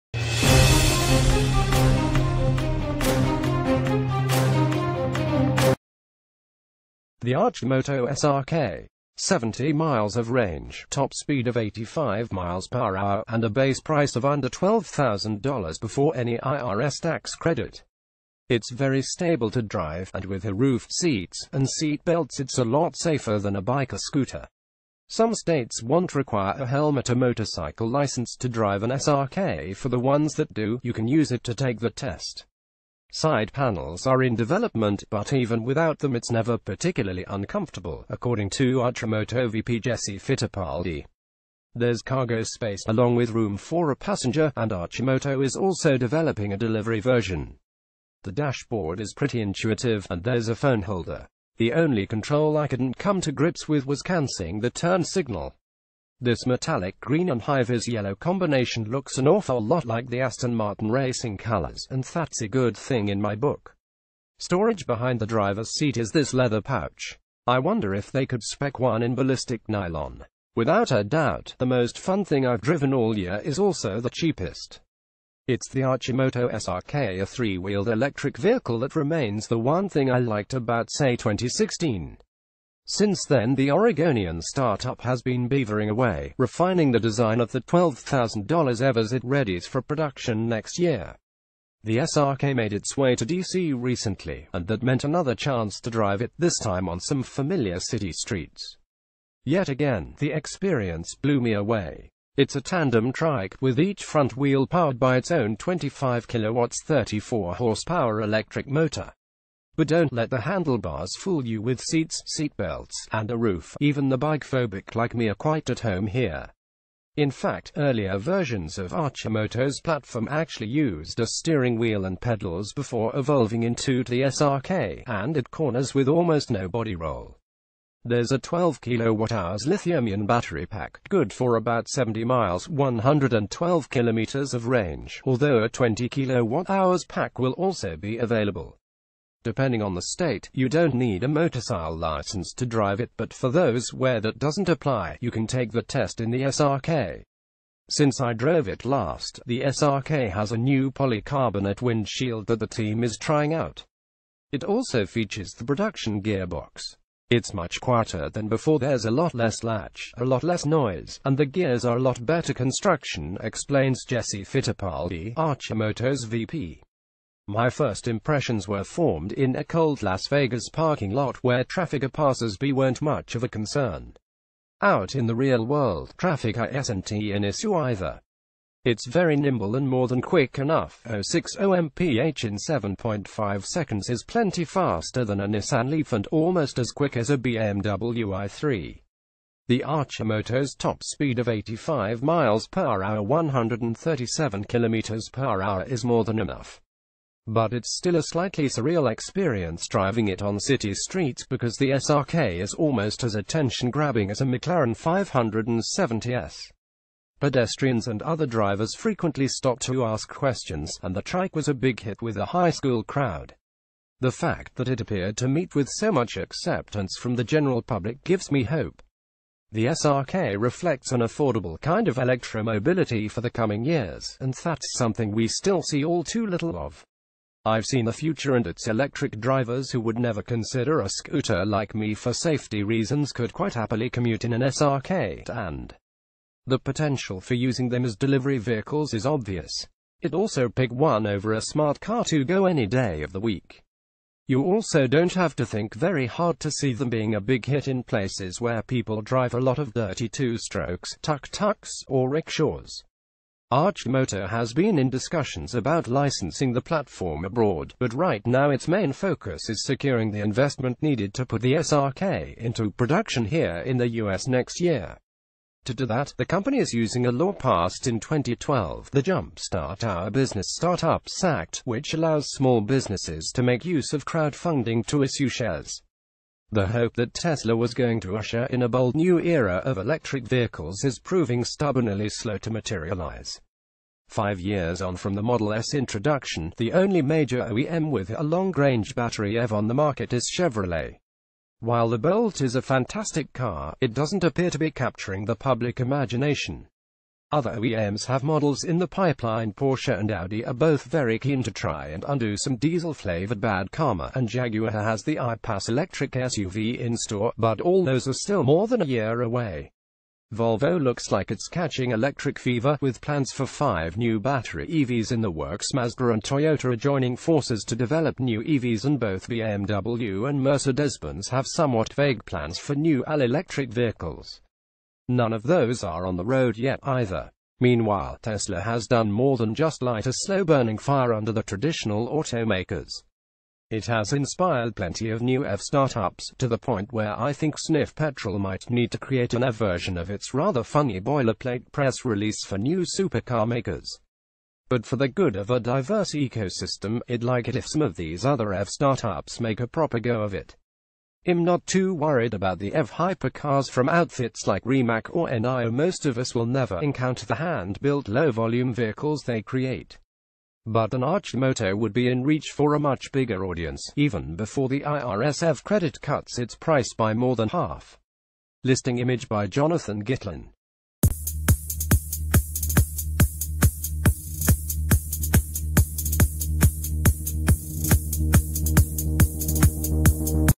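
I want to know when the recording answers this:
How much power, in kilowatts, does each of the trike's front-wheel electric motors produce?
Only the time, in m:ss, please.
1:45.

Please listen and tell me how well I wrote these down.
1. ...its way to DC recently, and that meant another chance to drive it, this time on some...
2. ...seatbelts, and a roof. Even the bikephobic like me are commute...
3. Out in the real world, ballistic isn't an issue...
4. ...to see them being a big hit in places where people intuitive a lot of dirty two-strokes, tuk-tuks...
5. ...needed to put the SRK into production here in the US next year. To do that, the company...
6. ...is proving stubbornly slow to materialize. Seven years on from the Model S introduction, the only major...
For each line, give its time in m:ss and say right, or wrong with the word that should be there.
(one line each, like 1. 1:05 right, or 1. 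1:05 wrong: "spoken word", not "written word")
1. 1:32 right
2. 1:52 wrong: "quite", not "commute"
3. 2:54 wrong: "traffic", not "ballistic"
4. 4:06 wrong: "drive", not "intuitive"
5. 4:21 right
6. 4:41 wrong: "Five", not "Seven".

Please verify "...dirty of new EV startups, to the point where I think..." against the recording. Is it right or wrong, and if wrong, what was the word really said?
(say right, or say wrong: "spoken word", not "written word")
wrong: "plenty", not "dirty".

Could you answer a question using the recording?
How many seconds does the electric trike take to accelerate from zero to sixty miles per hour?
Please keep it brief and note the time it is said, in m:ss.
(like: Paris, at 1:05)
7.5 seconds, at 3:02.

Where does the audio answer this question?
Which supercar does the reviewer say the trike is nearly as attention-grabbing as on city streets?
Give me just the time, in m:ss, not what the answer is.
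3:24.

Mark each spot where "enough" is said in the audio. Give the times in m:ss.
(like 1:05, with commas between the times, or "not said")
3:00, 3:16.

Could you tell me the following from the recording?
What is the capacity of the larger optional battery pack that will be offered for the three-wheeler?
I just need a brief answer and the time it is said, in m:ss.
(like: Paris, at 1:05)
20 kWh, at 2:15.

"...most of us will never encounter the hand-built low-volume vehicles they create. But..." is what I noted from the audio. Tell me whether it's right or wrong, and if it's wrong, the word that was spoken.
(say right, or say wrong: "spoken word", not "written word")
right.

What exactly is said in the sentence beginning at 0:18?
It's very stable to drive, and with roofed seats and seat belts it's a lot safer than a bike or scooter.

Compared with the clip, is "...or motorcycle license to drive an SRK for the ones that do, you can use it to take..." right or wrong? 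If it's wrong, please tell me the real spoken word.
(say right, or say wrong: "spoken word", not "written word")
right.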